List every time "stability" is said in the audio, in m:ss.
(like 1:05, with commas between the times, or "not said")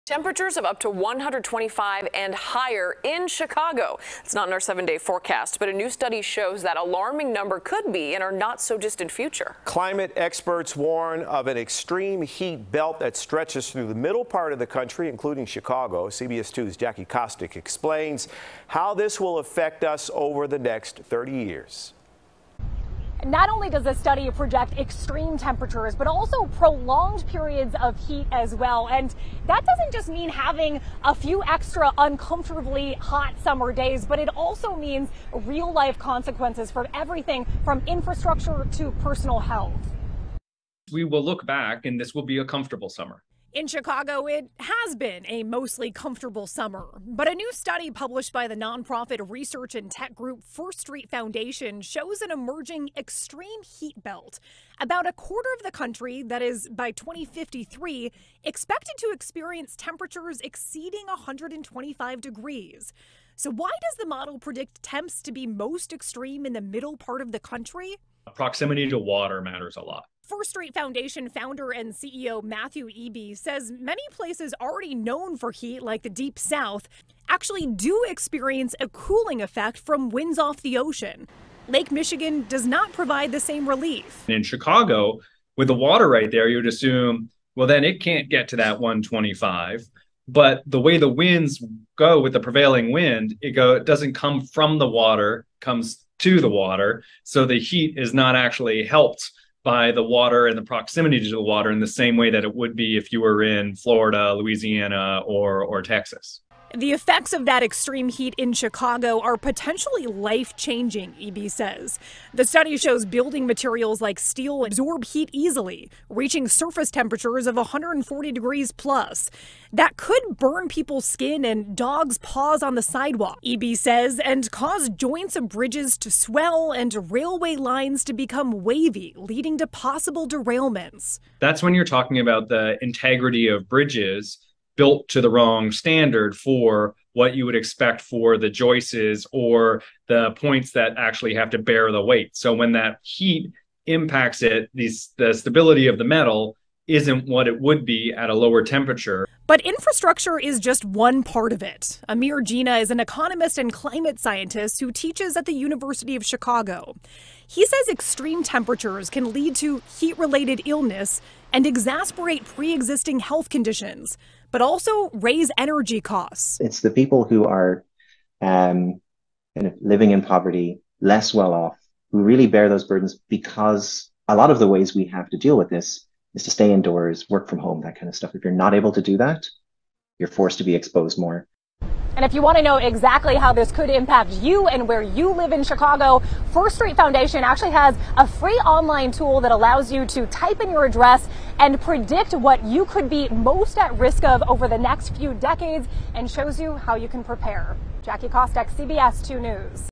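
2:25.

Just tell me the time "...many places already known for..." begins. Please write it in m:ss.
1:13.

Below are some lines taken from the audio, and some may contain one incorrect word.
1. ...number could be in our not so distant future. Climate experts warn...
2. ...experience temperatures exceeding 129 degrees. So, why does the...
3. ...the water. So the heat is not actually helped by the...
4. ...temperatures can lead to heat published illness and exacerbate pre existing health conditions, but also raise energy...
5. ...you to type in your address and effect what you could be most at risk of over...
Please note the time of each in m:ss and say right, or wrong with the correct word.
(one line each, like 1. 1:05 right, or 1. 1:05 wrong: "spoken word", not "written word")
1. 0:07 right
2. 0:59 wrong: "125", not "129"
3. 1:36 right
4. 2:38 wrong: "related", not "published"
5. 3:09 wrong: "predict", not "effect".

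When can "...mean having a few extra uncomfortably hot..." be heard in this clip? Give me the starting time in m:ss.
0:30.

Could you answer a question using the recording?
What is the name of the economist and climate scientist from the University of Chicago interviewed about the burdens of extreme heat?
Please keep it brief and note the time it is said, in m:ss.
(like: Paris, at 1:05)
Amir Jina, at 2:32.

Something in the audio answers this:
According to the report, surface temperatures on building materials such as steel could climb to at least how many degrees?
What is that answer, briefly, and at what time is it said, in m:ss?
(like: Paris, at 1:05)
140, at 1:57.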